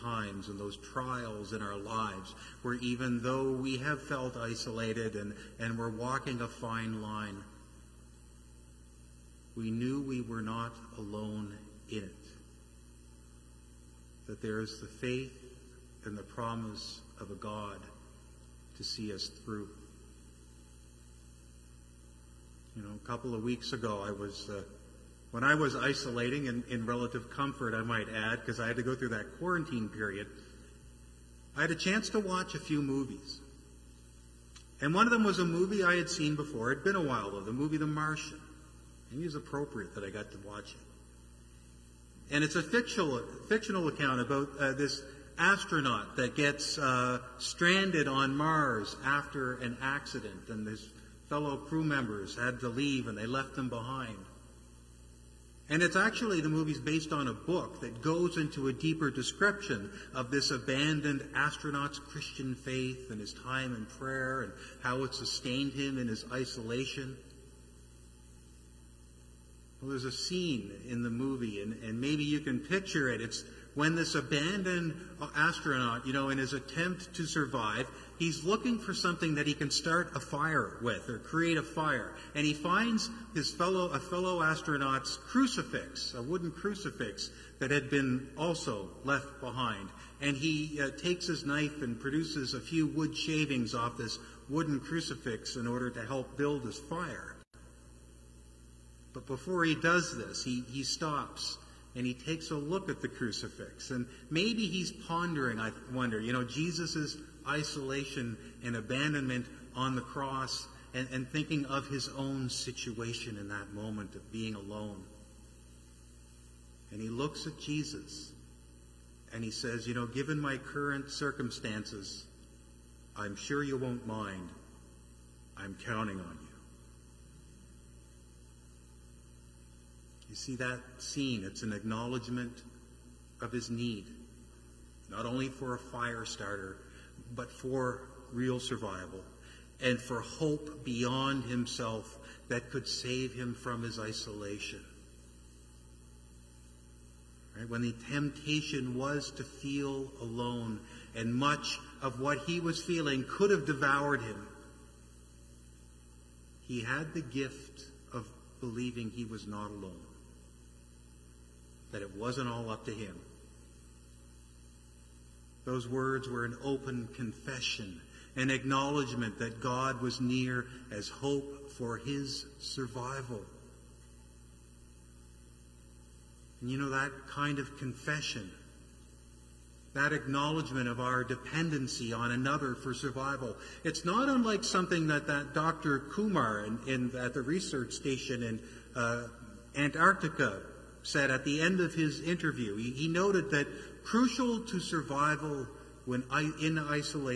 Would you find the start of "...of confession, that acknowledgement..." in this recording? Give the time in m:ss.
2:57.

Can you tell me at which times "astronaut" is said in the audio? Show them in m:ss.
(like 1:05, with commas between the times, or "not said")
0:45, 1:01, 1:15, 1:24.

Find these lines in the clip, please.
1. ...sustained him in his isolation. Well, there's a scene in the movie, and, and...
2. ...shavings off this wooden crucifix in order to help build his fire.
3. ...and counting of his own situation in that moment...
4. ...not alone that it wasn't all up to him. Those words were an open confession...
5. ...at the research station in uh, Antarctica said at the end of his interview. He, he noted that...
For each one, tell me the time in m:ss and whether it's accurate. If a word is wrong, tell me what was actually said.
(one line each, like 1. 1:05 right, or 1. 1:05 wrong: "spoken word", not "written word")
1. 1:05 right
2. 1:33 right
3. 1:51 wrong: "thinking", not "counting"
4. 2:39 right
5. 3:07 right.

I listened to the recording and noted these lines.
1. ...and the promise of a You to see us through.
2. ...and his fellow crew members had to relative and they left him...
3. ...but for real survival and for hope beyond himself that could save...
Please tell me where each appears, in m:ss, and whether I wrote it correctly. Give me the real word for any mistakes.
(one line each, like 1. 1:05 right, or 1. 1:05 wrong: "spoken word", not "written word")
1. 0:16 wrong: "God", not "You"
2. 0:50 wrong: "leave", not "relative"
3. 2:17 right.